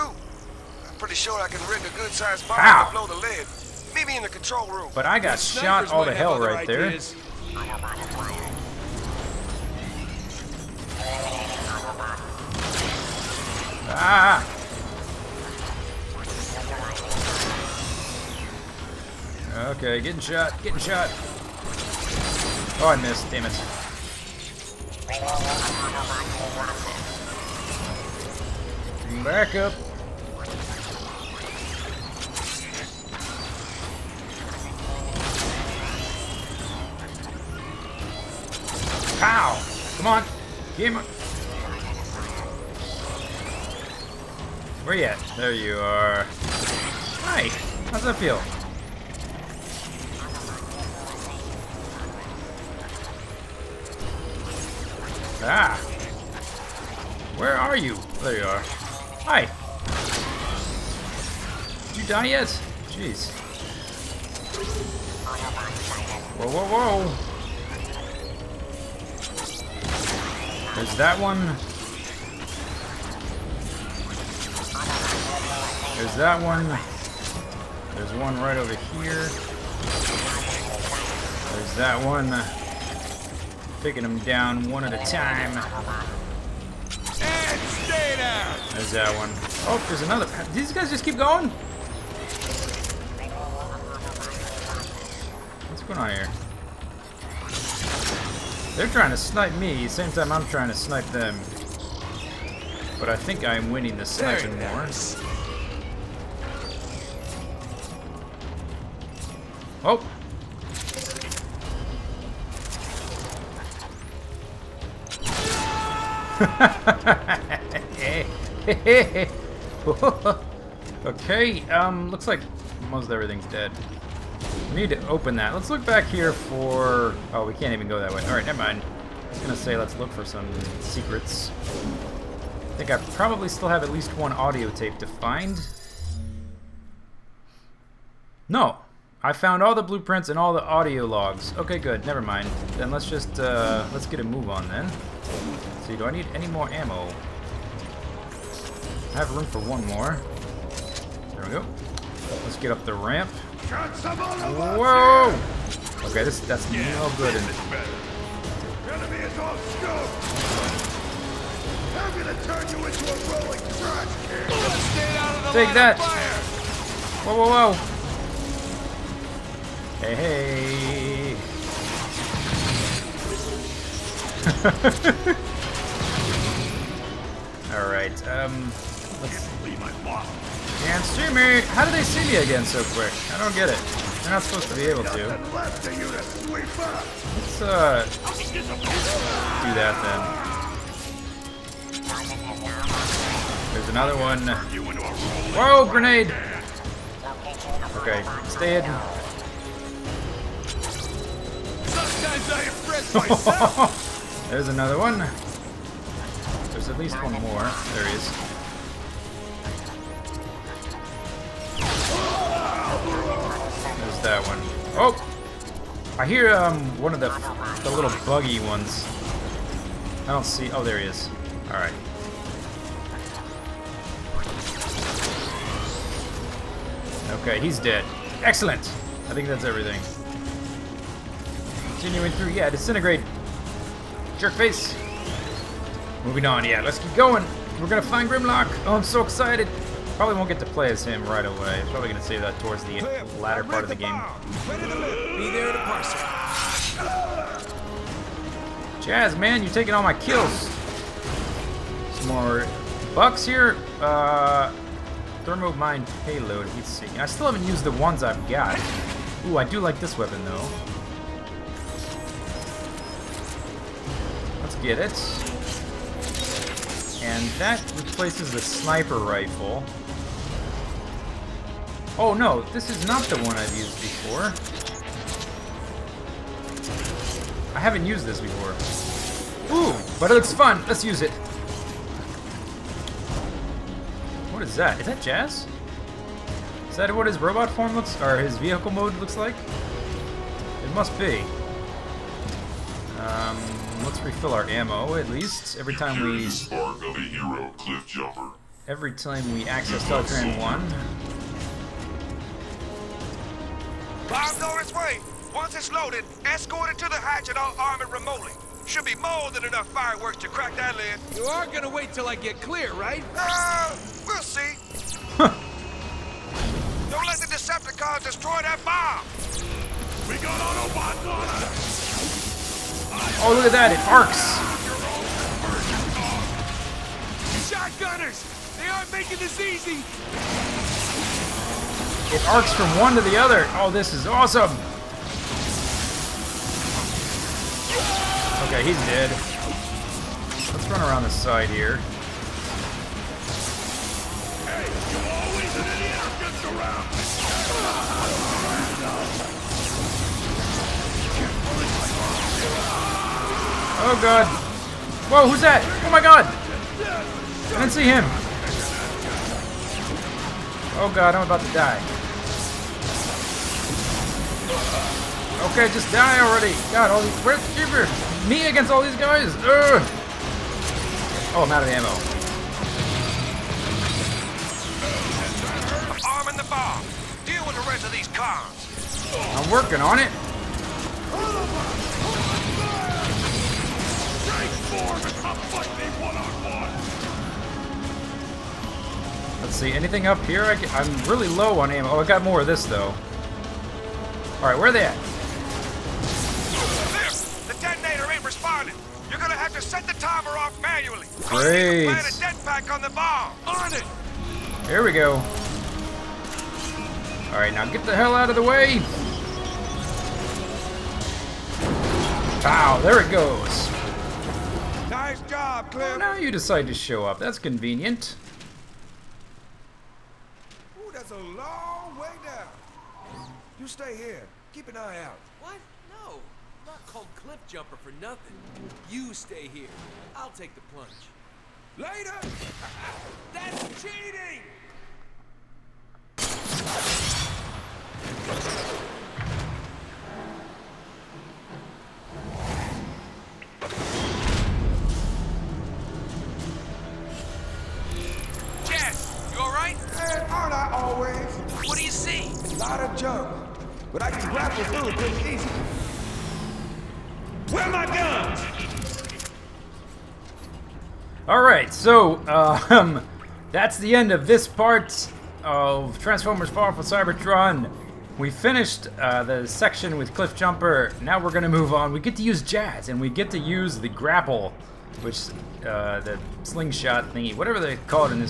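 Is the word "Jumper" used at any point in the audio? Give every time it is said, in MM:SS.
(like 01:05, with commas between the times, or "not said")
07:07, 07:50.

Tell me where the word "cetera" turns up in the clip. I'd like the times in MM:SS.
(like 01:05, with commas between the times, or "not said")
not said.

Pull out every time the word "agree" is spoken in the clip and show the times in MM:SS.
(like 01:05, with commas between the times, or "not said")
not said.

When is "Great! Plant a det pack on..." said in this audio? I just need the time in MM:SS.
06:41.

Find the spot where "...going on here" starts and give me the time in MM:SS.
01:35.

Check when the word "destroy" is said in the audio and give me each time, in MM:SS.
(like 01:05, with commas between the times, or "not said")
05:18.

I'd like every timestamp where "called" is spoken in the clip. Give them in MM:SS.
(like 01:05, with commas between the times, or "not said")
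07:07.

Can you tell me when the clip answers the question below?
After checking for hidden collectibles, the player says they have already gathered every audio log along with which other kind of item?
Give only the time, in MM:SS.
02:19.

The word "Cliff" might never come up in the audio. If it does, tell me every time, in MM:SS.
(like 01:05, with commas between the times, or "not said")
06:55, 07:07, 07:50.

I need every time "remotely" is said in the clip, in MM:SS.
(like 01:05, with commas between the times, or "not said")
05:08.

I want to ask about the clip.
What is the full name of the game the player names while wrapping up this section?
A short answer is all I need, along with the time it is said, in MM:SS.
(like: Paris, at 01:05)
Transformers Fall of Cybertron, at 07:46.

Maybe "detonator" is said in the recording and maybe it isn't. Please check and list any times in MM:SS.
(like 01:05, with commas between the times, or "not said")
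06:37.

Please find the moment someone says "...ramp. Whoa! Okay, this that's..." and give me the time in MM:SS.
02:32.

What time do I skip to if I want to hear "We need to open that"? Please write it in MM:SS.
02:04.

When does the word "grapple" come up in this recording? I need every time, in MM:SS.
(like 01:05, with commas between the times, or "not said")
07:34, 07:54.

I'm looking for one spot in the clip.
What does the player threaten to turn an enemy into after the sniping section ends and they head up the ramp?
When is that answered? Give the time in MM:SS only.
02:43.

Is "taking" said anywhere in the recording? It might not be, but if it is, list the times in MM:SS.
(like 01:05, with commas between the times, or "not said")
04:09.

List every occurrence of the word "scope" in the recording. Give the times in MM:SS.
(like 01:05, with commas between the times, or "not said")
02:39.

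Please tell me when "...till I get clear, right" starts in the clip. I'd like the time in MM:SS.
05:12.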